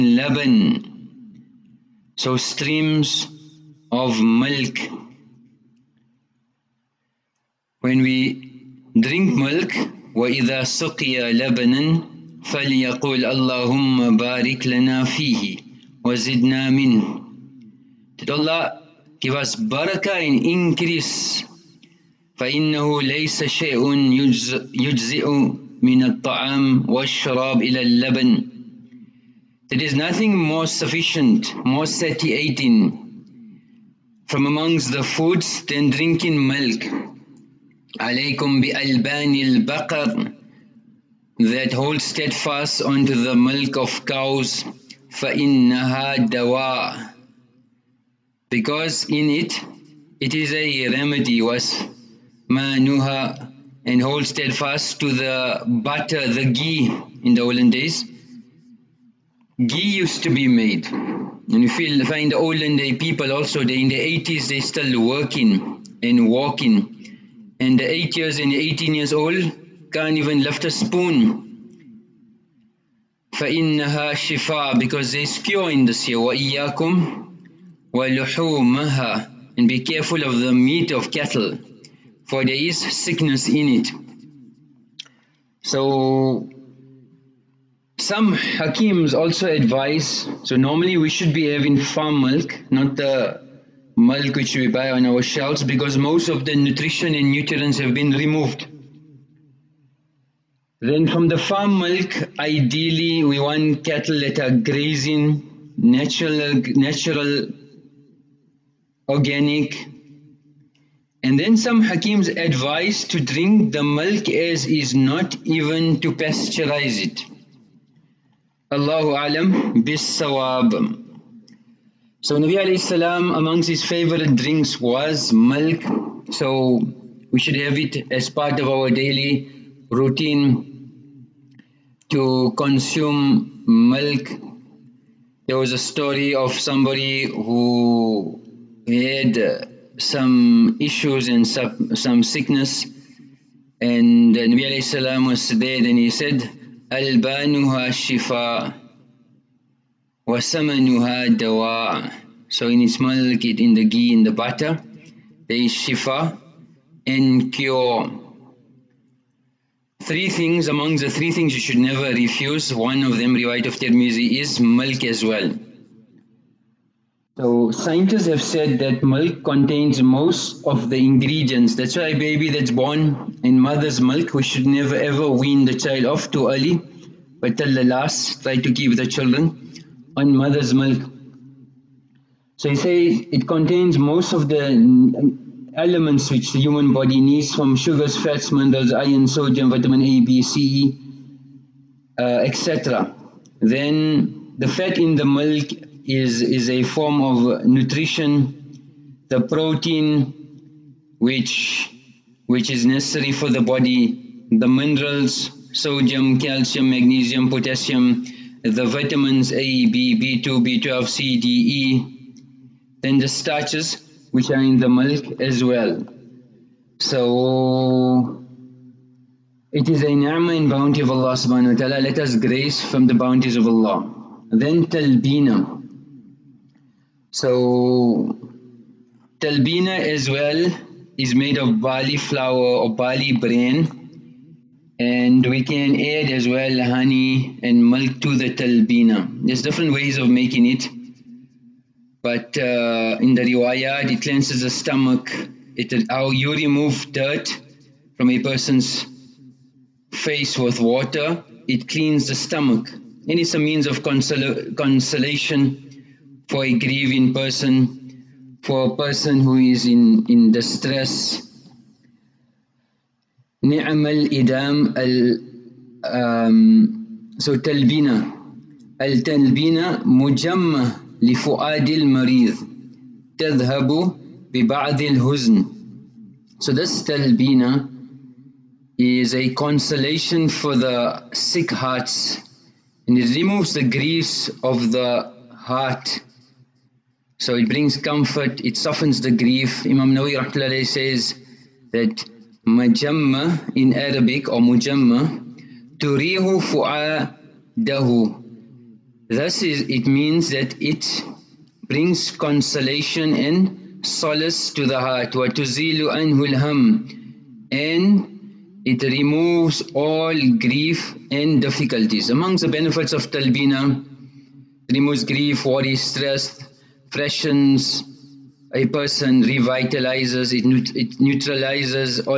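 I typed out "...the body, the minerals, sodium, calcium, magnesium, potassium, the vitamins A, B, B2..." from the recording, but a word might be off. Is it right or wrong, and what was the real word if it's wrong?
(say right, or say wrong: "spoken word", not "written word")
right.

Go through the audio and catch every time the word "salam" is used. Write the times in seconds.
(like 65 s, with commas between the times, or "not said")
122 s, 144 s.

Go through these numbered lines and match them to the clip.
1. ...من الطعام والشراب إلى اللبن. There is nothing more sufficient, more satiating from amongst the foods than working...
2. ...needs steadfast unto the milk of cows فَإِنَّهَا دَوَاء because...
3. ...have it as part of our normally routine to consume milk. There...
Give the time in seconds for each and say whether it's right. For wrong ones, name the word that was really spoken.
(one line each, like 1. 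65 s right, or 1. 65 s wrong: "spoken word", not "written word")
1. 25 s wrong: "drinking", not "working"
2. 41 s wrong: "holds", not "needs"
3. 127 s wrong: "daily", not "normally".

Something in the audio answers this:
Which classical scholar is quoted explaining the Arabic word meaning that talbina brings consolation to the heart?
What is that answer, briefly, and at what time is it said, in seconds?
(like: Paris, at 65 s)
Imam Nawawi, at 289 s.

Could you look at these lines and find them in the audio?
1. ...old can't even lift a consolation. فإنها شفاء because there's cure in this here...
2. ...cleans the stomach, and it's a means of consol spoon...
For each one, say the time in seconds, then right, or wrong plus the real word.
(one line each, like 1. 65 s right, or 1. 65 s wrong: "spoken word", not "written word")
1. 69 s wrong: "spoon", not "consolation"
2. 251 s wrong: "consolation", not "spoon".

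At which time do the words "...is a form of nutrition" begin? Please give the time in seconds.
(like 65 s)
196 s.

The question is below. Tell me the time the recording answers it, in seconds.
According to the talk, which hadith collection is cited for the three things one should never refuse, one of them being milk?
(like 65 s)
163 s.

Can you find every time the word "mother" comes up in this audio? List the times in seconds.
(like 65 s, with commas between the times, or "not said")
173 s, 180 s.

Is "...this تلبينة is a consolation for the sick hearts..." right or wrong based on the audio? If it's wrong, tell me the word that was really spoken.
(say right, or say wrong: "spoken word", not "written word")
right.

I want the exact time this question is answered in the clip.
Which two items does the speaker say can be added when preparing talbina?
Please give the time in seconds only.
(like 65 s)
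236 s.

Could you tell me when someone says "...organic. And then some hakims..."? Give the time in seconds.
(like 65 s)
109 s.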